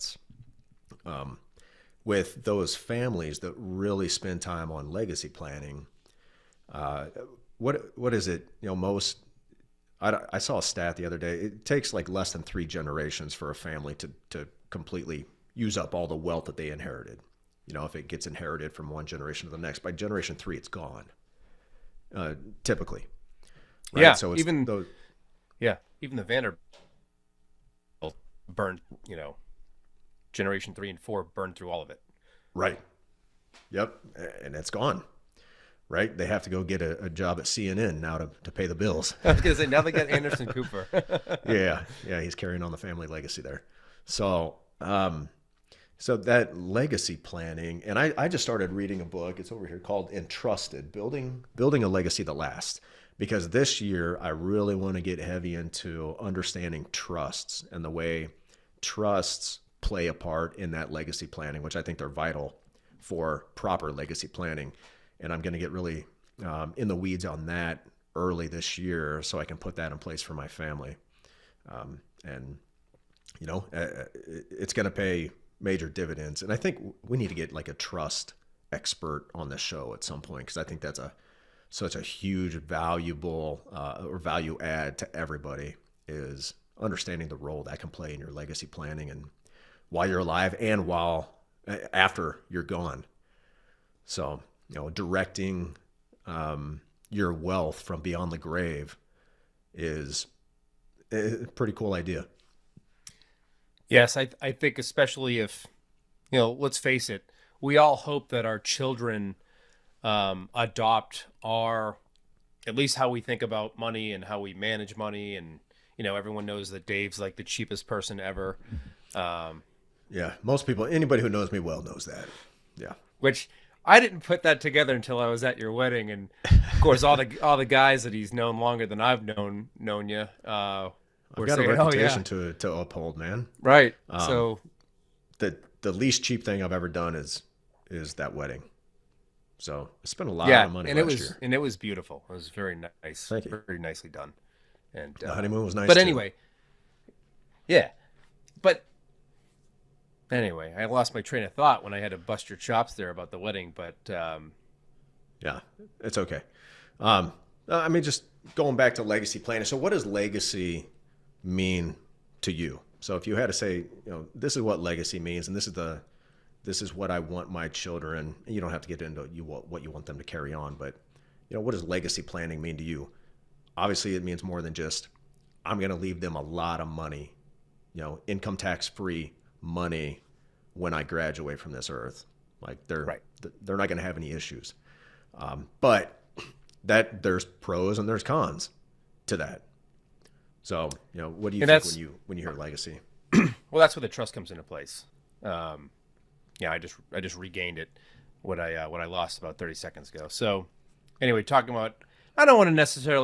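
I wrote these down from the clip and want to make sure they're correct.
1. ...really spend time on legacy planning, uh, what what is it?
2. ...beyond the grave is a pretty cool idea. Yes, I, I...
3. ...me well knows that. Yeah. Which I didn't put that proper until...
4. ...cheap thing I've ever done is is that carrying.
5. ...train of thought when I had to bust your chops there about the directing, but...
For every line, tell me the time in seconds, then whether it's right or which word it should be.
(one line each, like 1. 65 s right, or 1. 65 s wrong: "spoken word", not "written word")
1. 3 s right
2. 97 s right
3. 121 s wrong: "together", not "proper"
4. 136 s wrong: "wedding", not "carrying"
5. 151 s wrong: "wedding", not "directing".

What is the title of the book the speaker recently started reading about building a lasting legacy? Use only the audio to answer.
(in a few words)
Entrusted.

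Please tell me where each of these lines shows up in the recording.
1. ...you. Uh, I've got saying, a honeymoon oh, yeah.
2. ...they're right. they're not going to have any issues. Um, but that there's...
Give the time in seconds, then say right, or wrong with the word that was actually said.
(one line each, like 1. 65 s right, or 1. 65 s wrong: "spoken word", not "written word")
1. 130 s wrong: "reputation", not "honeymoon"
2. 182 s right.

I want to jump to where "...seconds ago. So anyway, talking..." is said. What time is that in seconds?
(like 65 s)
199 s.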